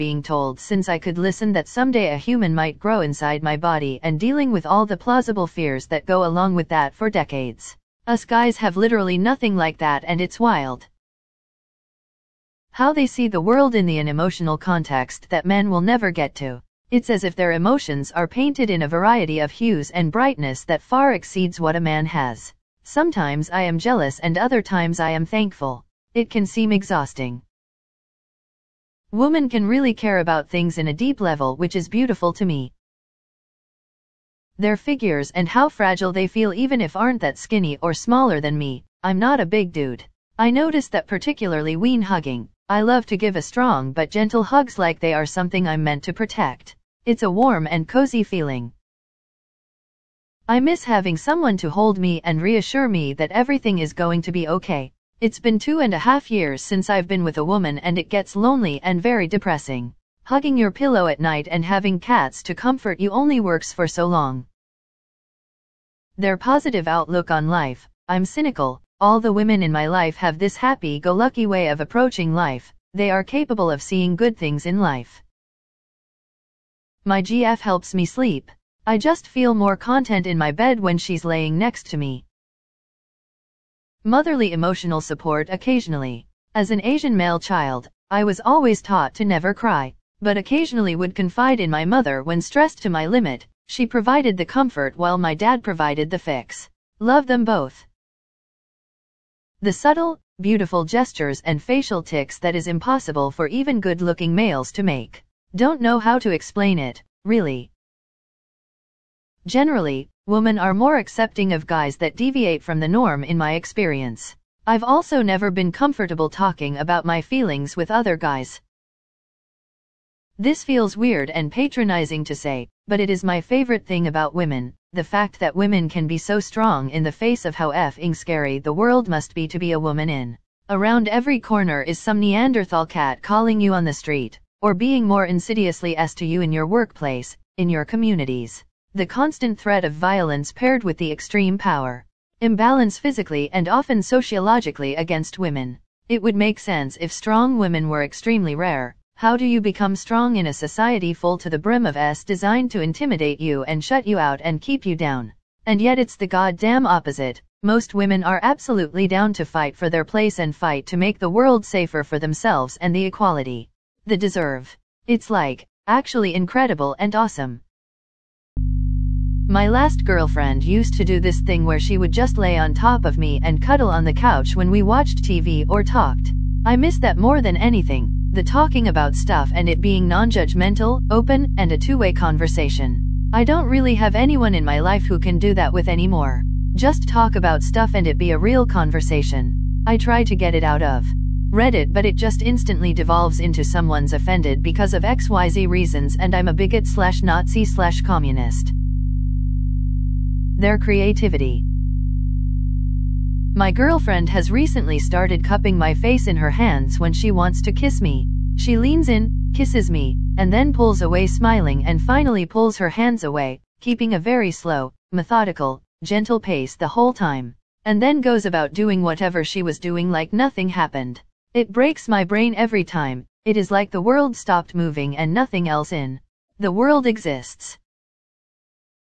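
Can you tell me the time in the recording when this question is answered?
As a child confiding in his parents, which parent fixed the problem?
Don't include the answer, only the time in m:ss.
1:35.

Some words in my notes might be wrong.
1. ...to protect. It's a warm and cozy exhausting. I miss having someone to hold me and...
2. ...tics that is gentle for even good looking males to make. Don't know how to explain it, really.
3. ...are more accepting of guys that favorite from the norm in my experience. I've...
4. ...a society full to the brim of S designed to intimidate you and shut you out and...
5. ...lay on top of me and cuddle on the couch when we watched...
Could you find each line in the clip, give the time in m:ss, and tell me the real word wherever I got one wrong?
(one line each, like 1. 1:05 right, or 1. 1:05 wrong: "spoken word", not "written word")
1. 0:46 wrong: "feeling", not "exhausting"
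2. 1:42 wrong: "impossible", not "gentle"
3. 1:50 wrong: "deviate", not "favorite"
4. 2:30 right
5. 2:52 right.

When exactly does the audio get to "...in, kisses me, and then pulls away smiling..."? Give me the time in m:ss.
3:29.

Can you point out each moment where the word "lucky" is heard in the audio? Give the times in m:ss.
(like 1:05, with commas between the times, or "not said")
1:10.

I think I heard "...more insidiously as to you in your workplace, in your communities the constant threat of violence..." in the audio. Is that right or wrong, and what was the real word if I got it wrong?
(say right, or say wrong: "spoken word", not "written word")
right.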